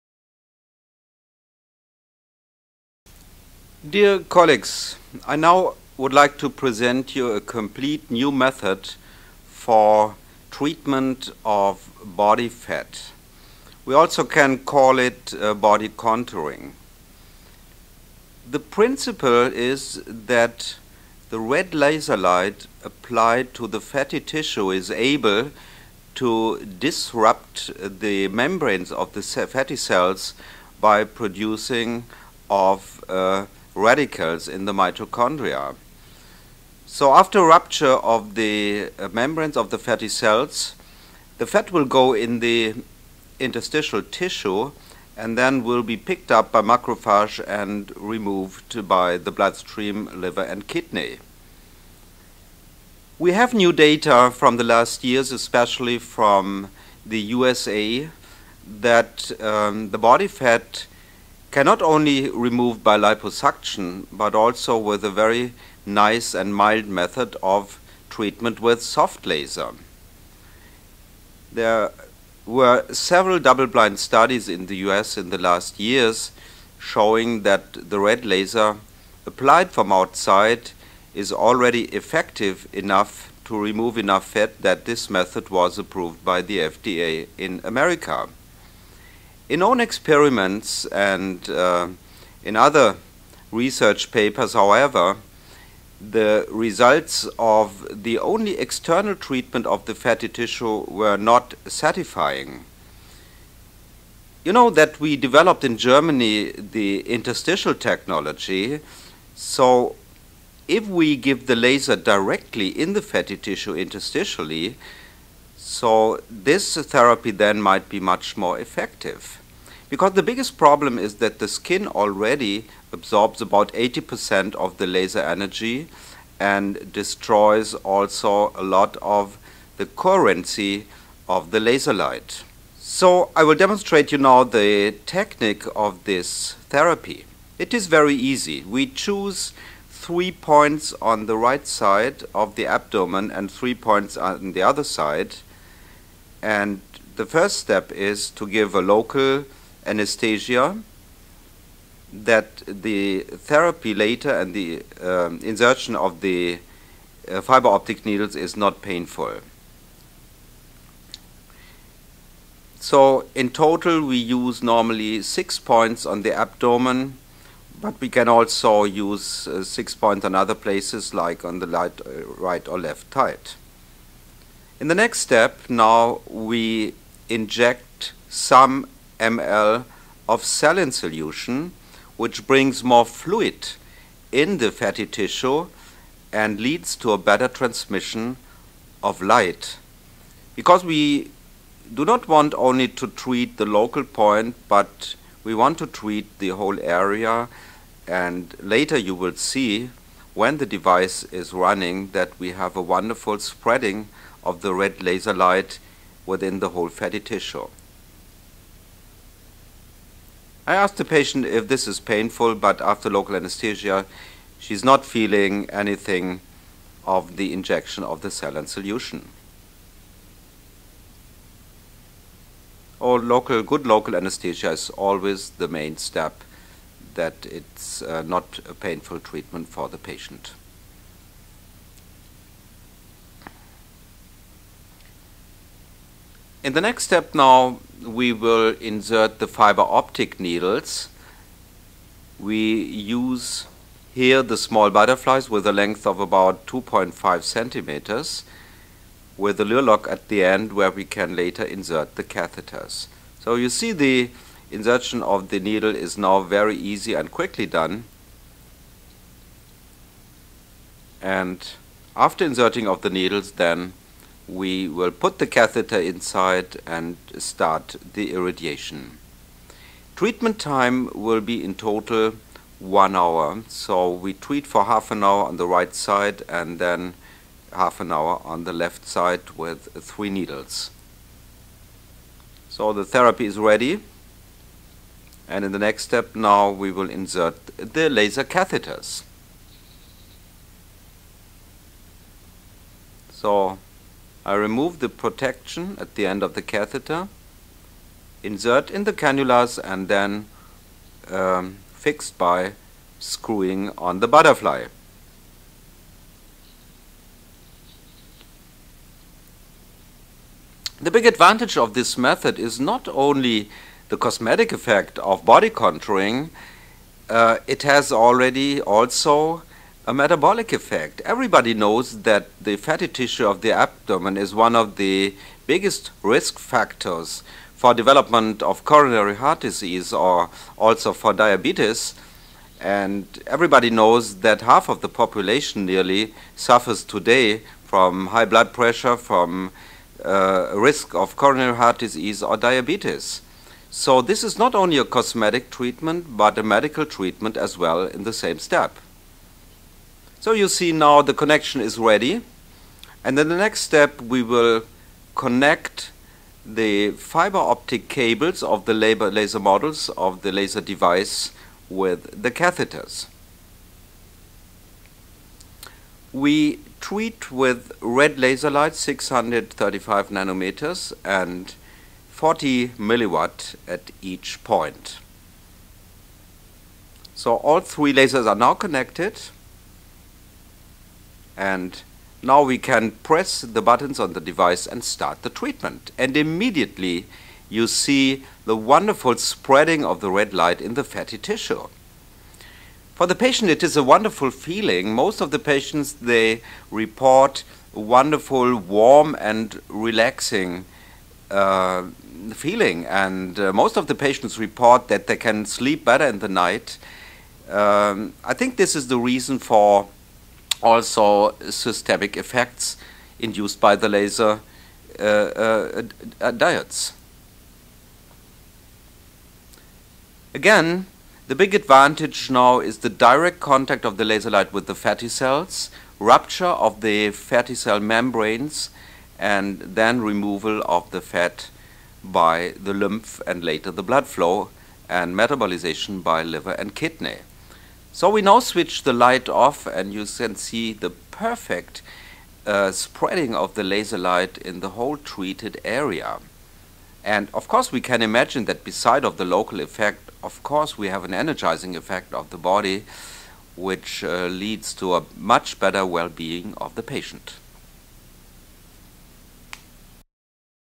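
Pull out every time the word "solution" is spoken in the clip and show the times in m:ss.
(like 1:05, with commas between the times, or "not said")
3:00, 3:38.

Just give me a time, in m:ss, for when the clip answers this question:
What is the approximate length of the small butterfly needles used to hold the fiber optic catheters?
4:06.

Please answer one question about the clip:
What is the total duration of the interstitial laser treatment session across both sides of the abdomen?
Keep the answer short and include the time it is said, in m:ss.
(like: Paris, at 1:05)
one hour, at 4:32.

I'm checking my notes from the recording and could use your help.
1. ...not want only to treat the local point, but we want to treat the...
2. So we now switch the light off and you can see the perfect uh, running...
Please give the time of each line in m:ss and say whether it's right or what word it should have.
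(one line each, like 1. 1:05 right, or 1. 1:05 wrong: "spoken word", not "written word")
1. 3:12 right
2. 7:18 wrong: "spreading", not "running".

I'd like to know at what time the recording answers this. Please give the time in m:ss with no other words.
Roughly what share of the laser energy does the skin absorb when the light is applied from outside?
2:03.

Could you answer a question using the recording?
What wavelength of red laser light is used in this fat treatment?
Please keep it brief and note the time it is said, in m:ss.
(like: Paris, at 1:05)
635 nanometers, at 6:08.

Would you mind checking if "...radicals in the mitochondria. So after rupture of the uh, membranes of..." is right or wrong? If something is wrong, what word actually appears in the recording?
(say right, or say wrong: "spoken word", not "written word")
right.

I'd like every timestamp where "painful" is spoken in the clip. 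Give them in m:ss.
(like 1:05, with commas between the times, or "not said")
2:38, 3:31, 3:48.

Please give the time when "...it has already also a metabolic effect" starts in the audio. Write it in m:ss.
5:17.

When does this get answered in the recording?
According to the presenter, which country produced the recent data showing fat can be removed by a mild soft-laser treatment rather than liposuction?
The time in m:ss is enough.
0:57.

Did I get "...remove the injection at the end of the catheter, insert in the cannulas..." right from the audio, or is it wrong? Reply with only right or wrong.
wrong.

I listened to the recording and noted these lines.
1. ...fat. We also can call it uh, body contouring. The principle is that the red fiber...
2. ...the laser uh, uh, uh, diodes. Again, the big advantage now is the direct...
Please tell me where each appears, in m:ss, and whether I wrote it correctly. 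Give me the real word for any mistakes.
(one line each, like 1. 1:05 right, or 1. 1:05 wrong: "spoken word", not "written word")
1. 0:12 wrong: "laser", not "fiber"
2. 6:53 right.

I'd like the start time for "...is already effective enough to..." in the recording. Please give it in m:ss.
1:21.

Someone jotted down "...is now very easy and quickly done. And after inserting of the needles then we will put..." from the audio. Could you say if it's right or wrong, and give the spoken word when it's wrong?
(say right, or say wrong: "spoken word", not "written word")
right.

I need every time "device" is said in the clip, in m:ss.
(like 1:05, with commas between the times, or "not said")
3:20, 6:00, 6:24.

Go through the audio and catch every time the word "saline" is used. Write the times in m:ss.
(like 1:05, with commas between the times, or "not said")
3:00, 3:38.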